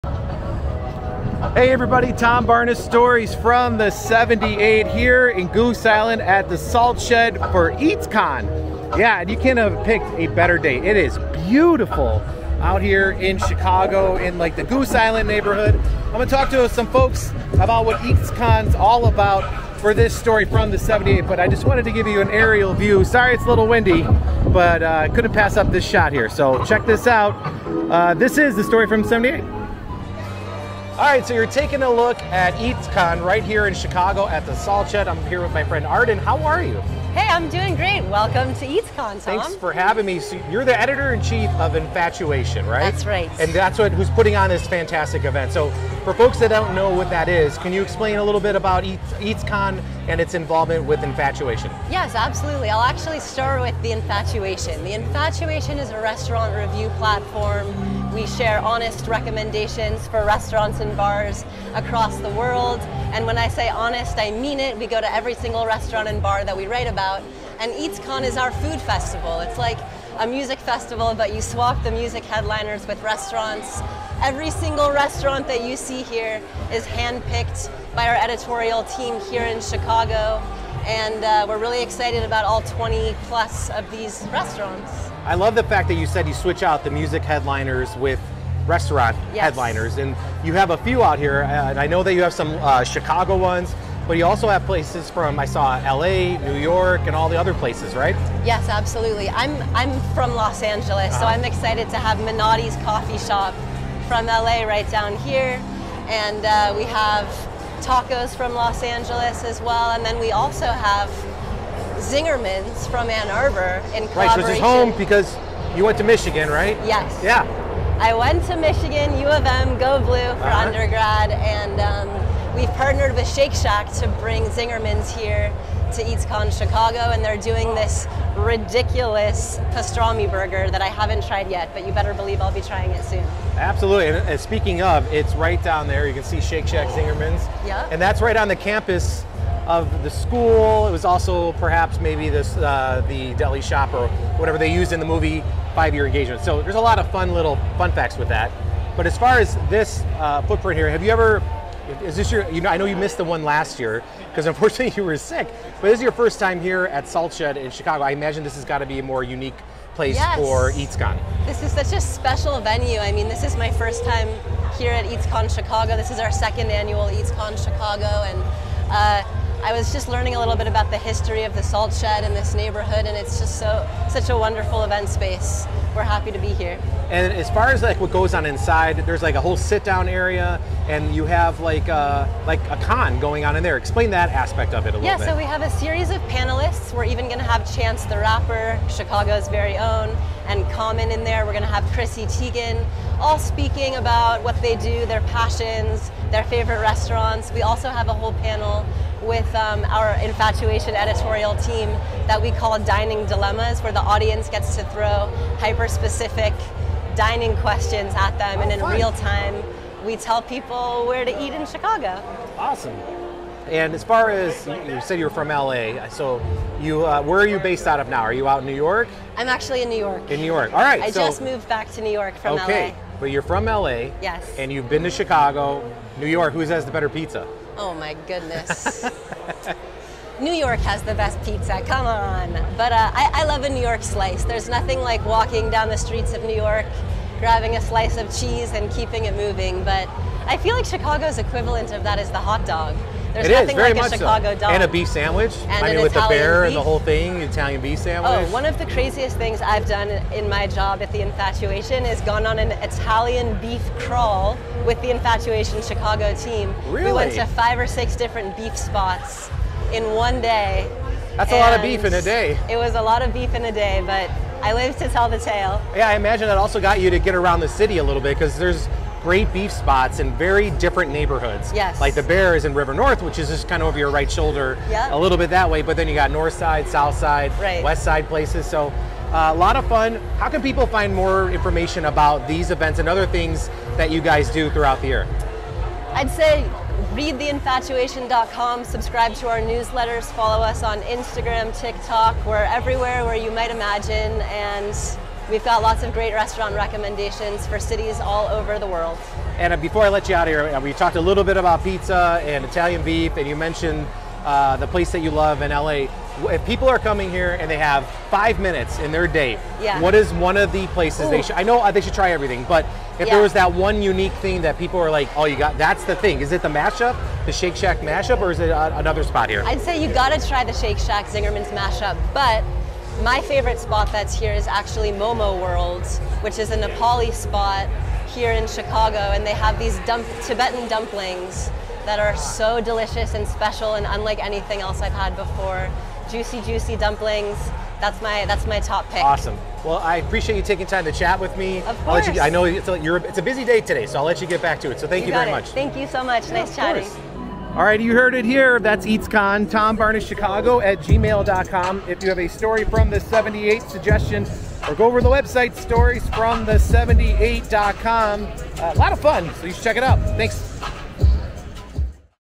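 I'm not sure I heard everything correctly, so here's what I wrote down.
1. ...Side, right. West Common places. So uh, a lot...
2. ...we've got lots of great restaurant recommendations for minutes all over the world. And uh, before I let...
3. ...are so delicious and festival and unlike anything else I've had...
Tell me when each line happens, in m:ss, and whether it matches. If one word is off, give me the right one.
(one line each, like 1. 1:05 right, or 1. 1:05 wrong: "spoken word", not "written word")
1. 4:37 wrong: "Side", not "Common"
2. 4:55 wrong: "cities", not "minutes"
3. 5:32 wrong: "special", not "festival".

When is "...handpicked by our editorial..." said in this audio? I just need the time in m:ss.
1:16.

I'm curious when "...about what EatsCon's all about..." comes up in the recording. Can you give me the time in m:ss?
0:17.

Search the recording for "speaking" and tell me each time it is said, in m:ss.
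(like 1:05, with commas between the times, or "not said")
2:14, 3:13.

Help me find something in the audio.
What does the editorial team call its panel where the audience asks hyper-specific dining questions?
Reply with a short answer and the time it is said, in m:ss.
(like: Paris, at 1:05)
Dining dilemmas, at 3:22.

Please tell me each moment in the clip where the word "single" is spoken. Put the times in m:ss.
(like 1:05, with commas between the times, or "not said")
1:05, 1:14.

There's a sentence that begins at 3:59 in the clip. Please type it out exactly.
But I feel like Chicago's equivalent of that is the hot dog.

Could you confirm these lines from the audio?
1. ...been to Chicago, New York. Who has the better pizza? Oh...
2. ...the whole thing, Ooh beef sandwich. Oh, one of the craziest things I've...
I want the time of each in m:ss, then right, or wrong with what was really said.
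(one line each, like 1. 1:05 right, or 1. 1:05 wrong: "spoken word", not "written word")
1. 3:44 right
2. 4:06 wrong: "Italian", not "Ooh".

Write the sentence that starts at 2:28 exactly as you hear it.
But as far as this uh, footprint here, have you ever is this your?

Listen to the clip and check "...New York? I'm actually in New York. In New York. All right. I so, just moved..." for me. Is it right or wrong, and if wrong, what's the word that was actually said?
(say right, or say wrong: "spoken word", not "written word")
right.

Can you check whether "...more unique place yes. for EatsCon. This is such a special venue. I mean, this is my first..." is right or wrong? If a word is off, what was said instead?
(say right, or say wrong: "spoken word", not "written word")
right.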